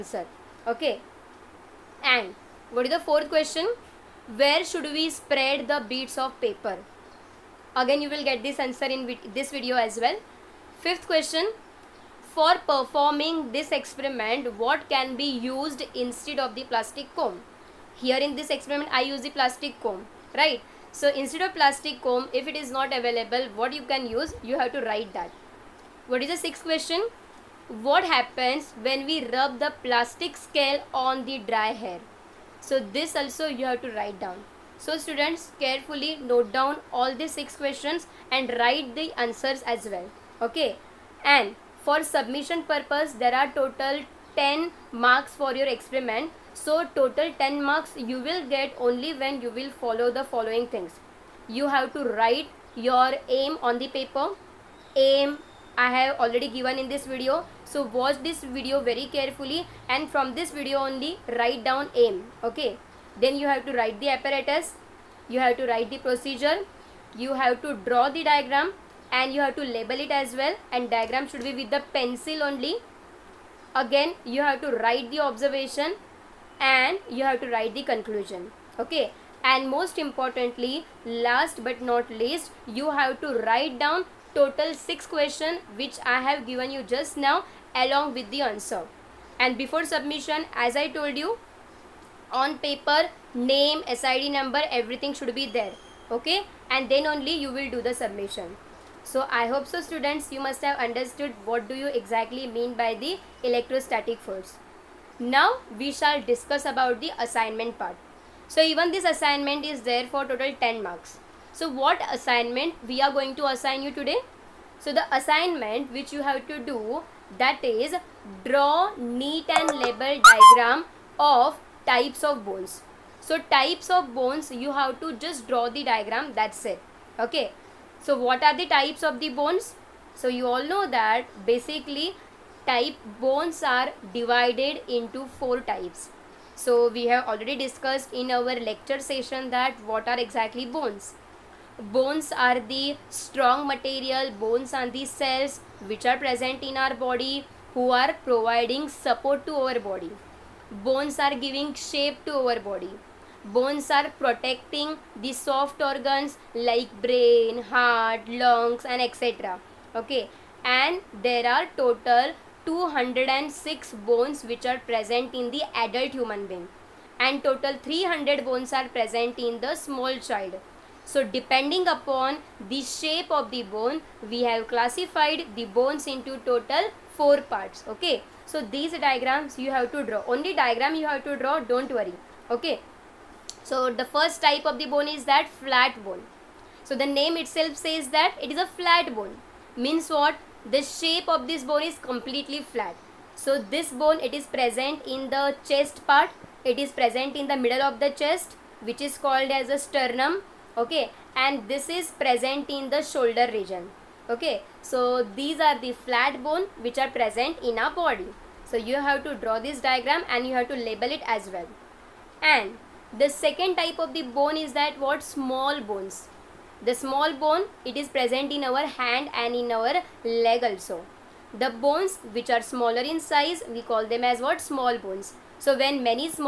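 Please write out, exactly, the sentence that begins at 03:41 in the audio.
The bones which are smaller in size, we call them as what?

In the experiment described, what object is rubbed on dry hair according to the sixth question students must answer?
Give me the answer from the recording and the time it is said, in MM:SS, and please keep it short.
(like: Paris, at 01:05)
plastic scale, at 00:29.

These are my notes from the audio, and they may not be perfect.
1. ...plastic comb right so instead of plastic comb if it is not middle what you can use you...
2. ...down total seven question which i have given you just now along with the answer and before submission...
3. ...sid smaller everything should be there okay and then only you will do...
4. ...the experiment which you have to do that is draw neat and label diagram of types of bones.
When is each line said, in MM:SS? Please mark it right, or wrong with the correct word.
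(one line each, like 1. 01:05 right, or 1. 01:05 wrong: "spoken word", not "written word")
1. 00:19 wrong: "available", not "middle"
2. 01:23 wrong: "six", not "seven"
3. 01:34 wrong: "number", not "smaller"
4. 01:54 wrong: "assignment", not "experiment".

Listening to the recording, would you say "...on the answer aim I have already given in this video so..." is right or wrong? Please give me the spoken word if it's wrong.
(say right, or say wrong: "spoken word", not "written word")
wrong: "paper", not "answer".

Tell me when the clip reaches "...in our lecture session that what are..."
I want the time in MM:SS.
02:18.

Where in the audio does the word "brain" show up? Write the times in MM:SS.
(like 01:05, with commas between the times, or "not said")
02:37.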